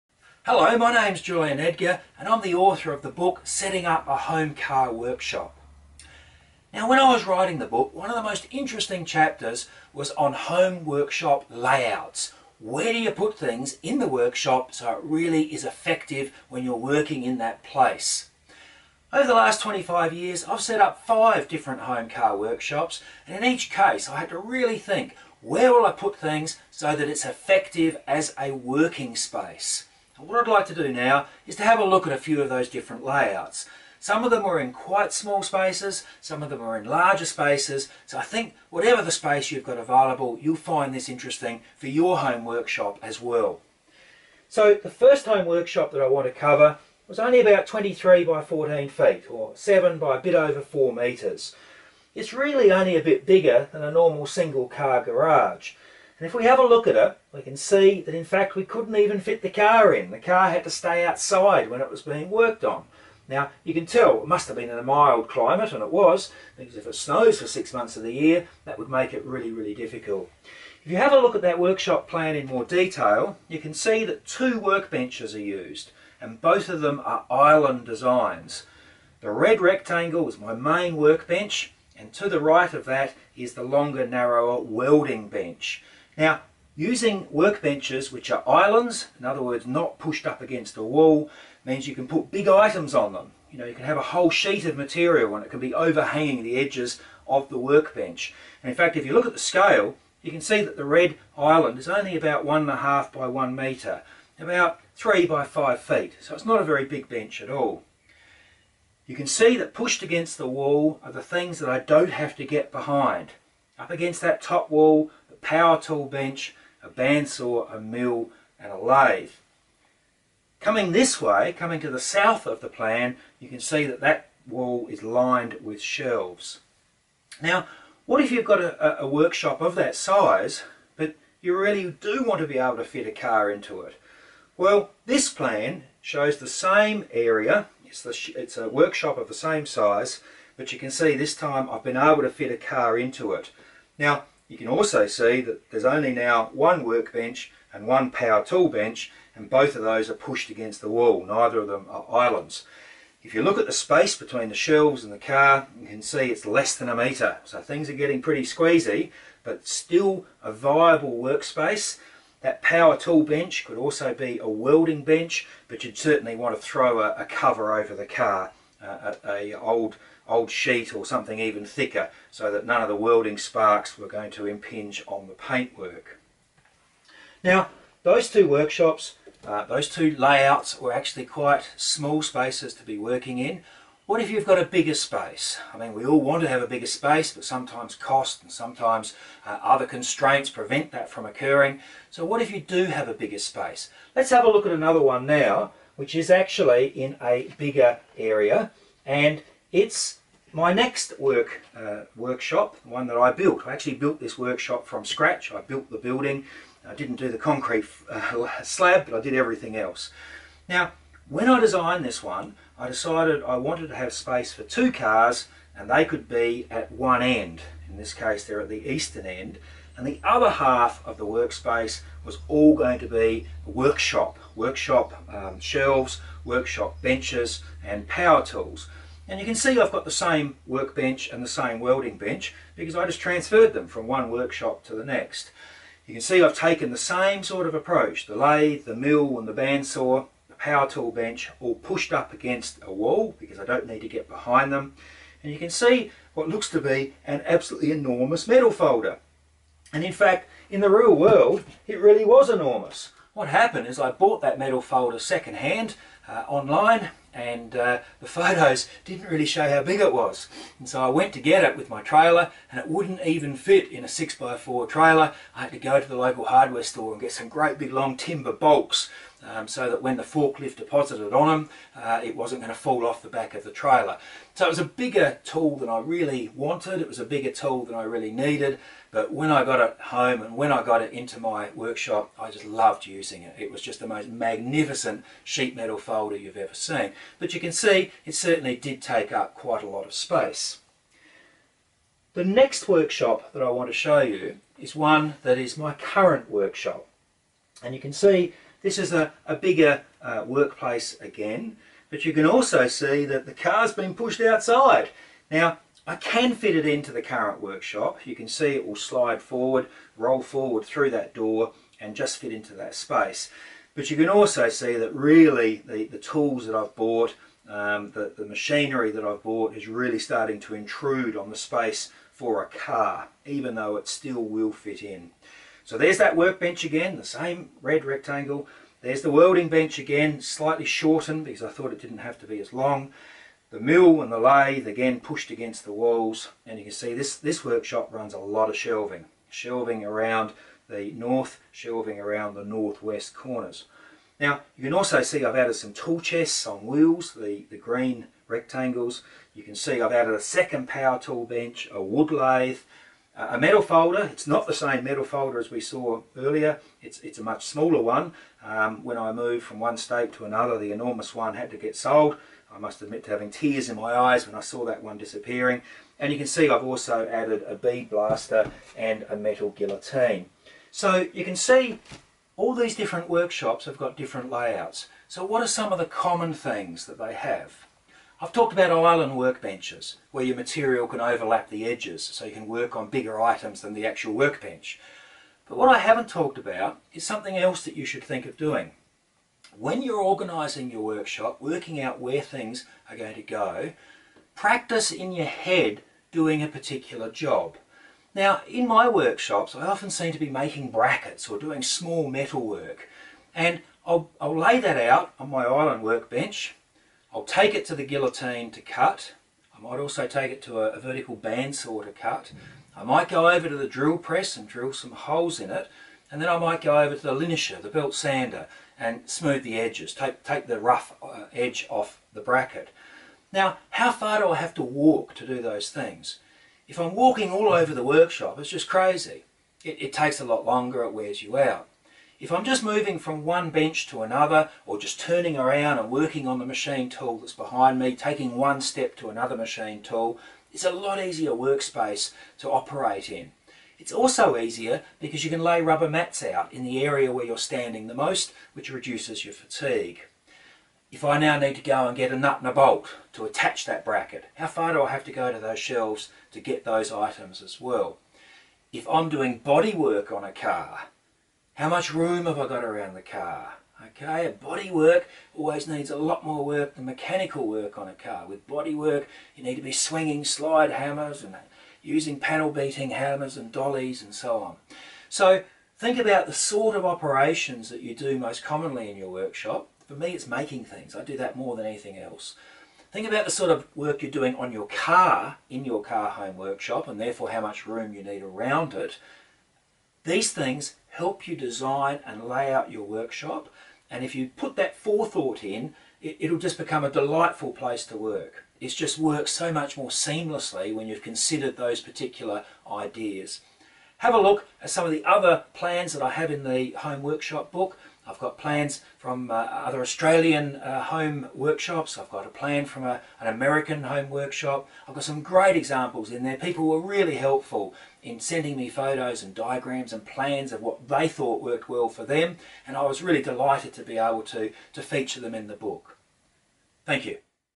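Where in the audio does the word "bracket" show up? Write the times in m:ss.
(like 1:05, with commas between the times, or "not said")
6:40, 7:02, 7:34.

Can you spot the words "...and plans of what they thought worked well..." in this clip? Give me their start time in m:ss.
8:40.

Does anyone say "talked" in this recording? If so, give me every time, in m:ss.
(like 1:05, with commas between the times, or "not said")
6:18, 6:26.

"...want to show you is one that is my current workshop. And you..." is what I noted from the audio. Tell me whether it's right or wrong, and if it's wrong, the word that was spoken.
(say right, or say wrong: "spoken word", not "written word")
right.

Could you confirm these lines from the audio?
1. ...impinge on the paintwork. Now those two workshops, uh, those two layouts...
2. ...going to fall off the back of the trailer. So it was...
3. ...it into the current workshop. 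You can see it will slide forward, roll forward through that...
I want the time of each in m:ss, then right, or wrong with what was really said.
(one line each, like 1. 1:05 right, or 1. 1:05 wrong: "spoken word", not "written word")
1. 2:54 right
2. 4:32 right
3. 5:06 right.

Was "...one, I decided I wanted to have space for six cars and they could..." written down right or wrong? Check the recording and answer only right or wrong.
wrong.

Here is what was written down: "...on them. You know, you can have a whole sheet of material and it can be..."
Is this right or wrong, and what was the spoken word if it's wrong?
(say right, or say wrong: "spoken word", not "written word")
right.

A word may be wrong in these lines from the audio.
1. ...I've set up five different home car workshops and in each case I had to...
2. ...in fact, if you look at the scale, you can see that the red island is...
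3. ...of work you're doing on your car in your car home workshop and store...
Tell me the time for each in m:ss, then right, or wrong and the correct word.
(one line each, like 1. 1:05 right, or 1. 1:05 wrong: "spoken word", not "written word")
1. 0:20 right
2. 1:38 right
3. 8:03 wrong: "therefore", not "store".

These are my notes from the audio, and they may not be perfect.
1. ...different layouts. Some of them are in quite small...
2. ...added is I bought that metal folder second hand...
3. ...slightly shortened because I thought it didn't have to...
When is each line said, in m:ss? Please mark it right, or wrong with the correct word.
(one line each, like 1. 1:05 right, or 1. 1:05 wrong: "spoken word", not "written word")
1. 0:32 right
2. 4:13 wrong: "happened", not "added"
3. 5:30 right.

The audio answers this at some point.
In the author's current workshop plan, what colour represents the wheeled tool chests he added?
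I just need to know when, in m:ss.
5:47.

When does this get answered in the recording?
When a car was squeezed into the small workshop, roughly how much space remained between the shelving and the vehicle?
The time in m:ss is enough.
2:36.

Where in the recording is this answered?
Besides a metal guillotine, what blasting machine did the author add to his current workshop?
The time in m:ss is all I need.
6:07.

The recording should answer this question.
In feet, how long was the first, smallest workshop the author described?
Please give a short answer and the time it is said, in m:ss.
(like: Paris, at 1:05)
23 feet, at 0:47.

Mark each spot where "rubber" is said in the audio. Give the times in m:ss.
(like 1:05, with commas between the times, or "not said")
7:25.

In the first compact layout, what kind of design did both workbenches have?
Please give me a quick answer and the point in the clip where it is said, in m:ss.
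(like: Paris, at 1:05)
Island designs, at 1:17.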